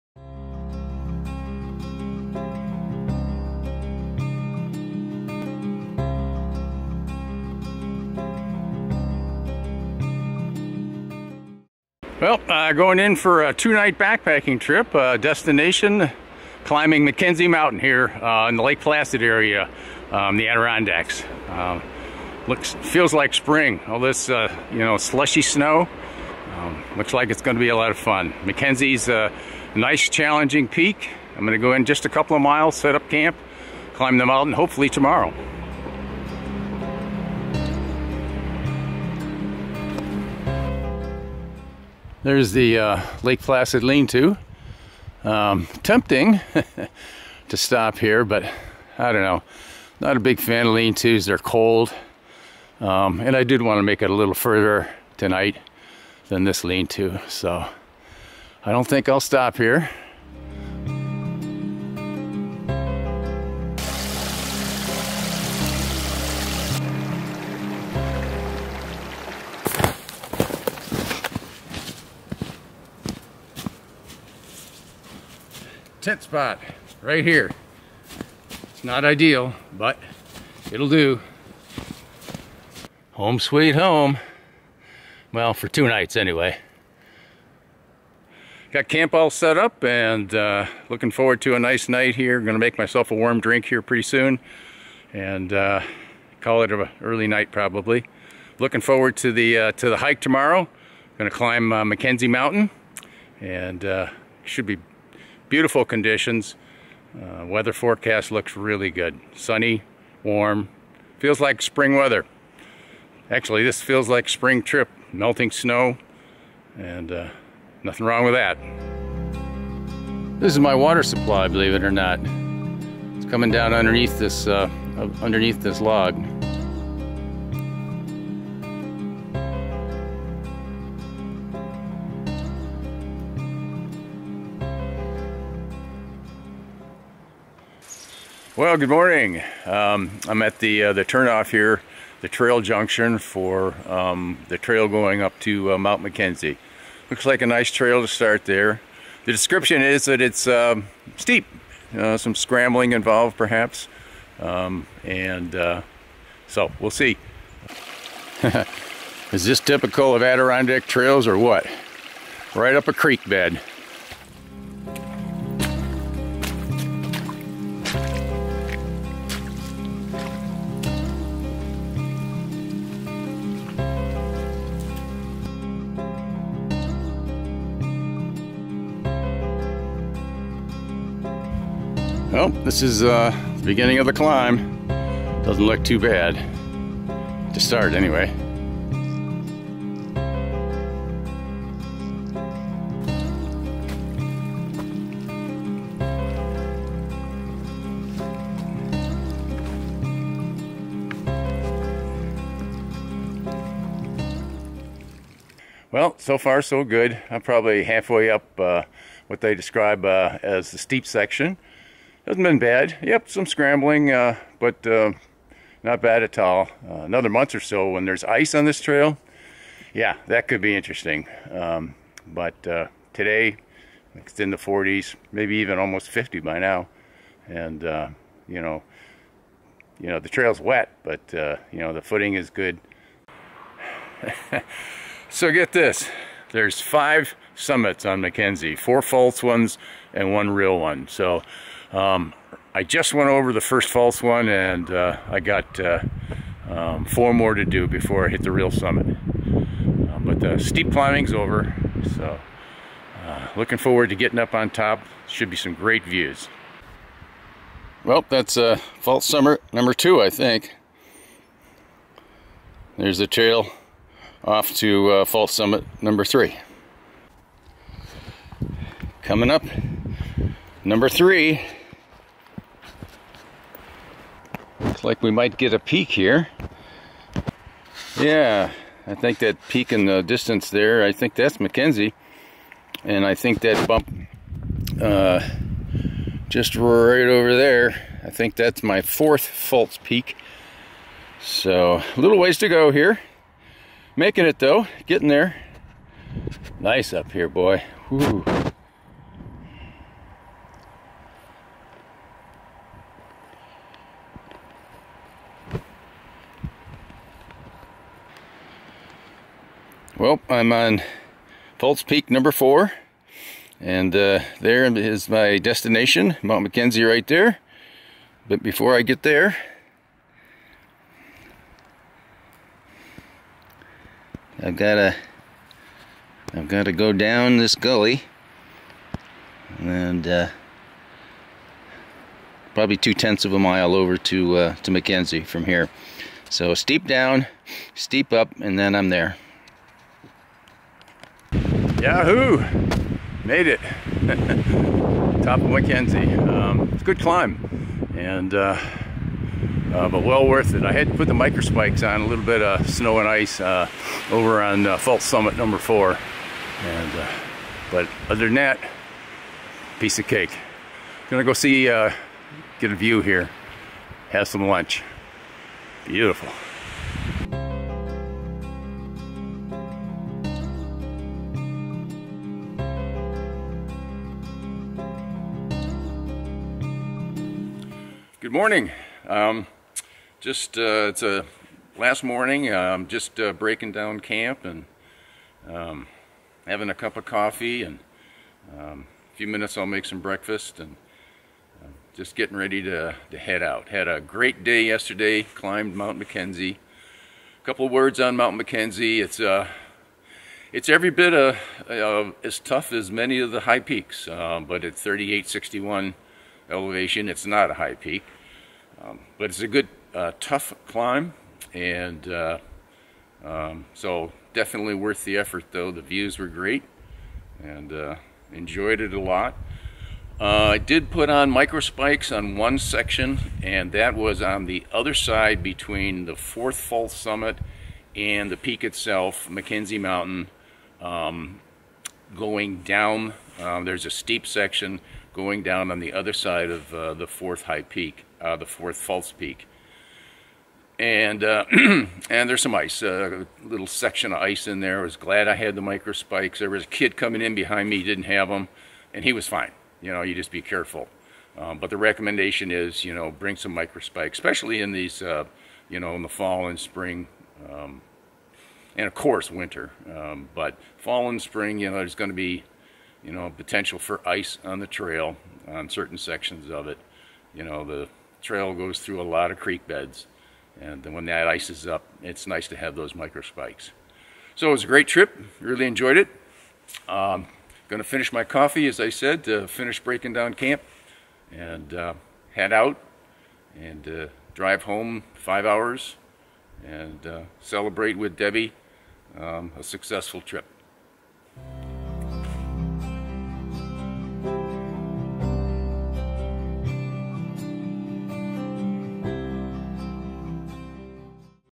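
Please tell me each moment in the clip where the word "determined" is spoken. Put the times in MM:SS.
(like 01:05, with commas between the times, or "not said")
not said.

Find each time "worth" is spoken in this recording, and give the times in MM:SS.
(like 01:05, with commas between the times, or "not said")
05:50, 06:54.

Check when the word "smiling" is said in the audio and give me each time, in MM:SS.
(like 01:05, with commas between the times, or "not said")
not said.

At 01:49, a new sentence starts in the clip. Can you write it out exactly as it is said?
Sunny, warm, feels like spring weather.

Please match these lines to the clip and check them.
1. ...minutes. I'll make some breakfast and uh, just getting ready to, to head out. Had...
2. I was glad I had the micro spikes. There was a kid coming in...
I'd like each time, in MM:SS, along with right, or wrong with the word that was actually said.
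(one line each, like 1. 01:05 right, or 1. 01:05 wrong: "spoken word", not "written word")
1. 06:29 right
2. 07:24 right.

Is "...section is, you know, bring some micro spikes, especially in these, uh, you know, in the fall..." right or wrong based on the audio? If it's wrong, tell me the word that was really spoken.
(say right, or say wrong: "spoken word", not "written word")
wrong: "recommendation", not "section".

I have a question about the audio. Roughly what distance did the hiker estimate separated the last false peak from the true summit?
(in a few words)
two tenths of a mile.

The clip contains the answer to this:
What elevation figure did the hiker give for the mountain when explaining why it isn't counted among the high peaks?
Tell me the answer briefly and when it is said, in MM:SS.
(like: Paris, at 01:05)
3861, at 06:44.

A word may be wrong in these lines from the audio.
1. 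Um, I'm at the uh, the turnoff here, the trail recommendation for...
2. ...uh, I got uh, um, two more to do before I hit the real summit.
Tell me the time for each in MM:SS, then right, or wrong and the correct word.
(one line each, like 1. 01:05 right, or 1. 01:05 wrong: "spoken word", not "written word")
1. 02:19 wrong: "junction", not "recommendation"
2. 04:04 wrong: "four", not "two".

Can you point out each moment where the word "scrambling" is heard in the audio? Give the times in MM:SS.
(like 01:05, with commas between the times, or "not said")
02:32, 03:33.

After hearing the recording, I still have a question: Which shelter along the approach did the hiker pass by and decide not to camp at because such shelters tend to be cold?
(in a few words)
Lake Placid lean-to.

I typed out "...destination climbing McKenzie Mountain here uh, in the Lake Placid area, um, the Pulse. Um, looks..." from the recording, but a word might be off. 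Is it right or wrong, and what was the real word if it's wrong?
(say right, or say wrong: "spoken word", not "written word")
wrong: "Adirondacks", not "Pulse".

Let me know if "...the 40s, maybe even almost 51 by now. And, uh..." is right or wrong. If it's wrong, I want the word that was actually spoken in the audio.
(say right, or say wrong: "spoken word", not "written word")
wrong: "50", not "51".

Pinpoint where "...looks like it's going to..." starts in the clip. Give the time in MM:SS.
00:26.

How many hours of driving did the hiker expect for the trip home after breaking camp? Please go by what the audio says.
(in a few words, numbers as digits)
5.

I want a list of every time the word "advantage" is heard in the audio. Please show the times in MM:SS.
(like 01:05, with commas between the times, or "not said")
not said.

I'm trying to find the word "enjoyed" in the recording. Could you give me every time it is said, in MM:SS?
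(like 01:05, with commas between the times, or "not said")
06:58, 07:55.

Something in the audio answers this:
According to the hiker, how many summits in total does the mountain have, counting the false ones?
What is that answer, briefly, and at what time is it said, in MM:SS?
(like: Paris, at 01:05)
5, at 03:56.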